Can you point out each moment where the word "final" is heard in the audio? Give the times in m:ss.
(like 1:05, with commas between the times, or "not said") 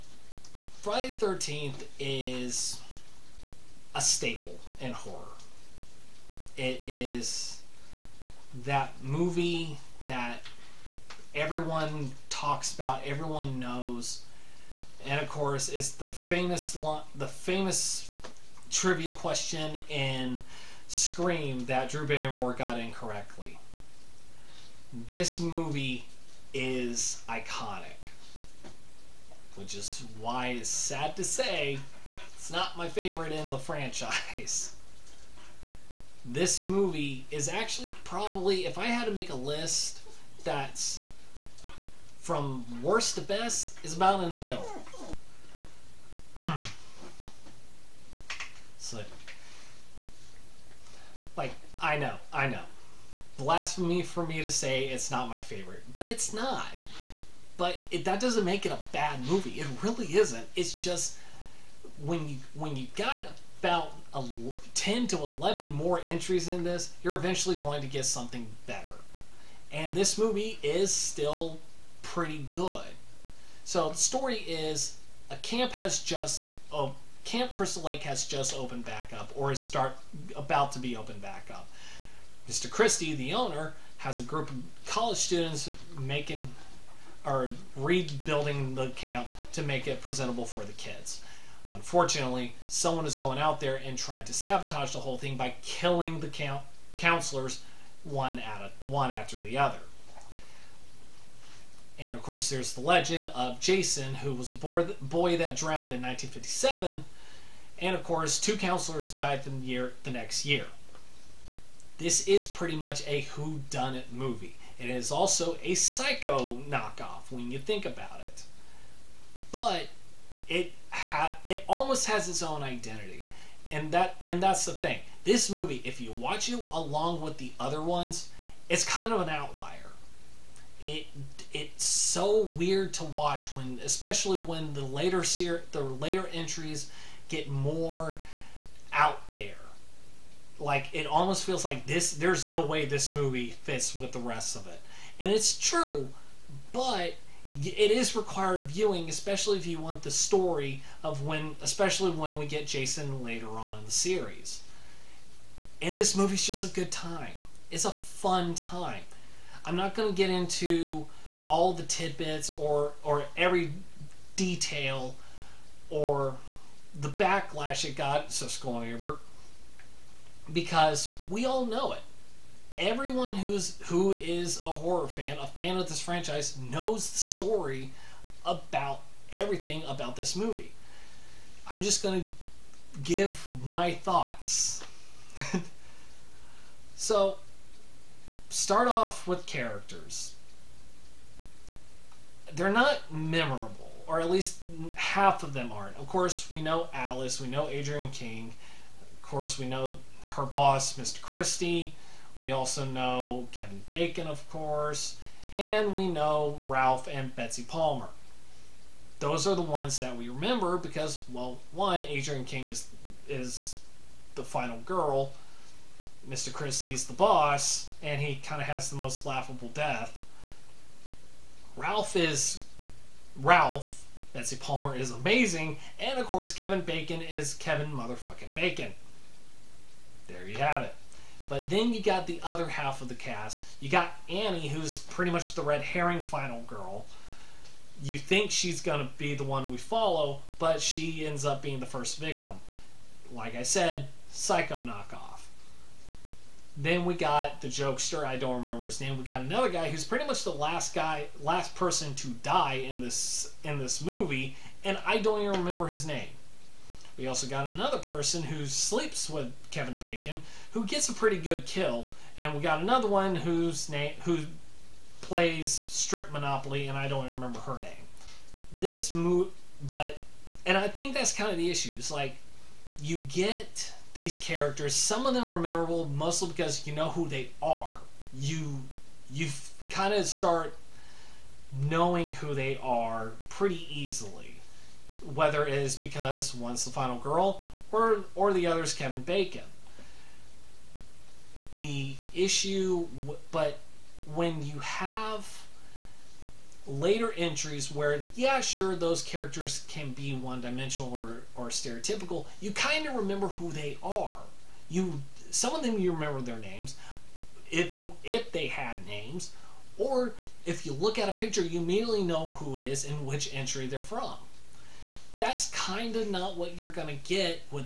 3:34, 3:56, 4:46.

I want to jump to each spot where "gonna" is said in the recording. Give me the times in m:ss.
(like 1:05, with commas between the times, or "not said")
3:02, 5:16.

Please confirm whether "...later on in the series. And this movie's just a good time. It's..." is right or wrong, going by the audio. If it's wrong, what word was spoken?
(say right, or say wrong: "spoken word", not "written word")
right.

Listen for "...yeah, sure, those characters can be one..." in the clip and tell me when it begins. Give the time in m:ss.
4:58.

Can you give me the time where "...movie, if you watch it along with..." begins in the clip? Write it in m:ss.
2:05.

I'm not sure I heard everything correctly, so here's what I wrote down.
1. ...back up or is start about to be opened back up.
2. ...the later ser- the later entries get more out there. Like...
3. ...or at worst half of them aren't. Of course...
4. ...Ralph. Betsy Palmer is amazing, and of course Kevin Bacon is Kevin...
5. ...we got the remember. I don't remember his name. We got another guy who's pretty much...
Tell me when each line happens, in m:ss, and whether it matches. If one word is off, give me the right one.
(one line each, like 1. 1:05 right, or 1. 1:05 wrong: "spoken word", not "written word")
1. 1:18 right
2. 2:14 right
3. 3:14 wrong: "least", not "worst"
4. 3:43 right
5. 4:07 wrong: "jokester", not "remember".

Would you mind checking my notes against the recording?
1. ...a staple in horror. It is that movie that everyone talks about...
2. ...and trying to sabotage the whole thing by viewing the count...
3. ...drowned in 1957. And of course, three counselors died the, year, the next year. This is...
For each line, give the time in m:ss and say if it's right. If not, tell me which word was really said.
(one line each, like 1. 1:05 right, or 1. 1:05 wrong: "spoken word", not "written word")
1. 0:03 right
2. 1:33 wrong: "killing", not "viewing"
3. 1:45 wrong: "two", not "three".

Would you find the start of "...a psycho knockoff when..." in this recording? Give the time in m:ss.
1:55.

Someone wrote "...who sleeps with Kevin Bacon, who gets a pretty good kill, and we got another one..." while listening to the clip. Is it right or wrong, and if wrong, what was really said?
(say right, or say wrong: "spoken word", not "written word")
right.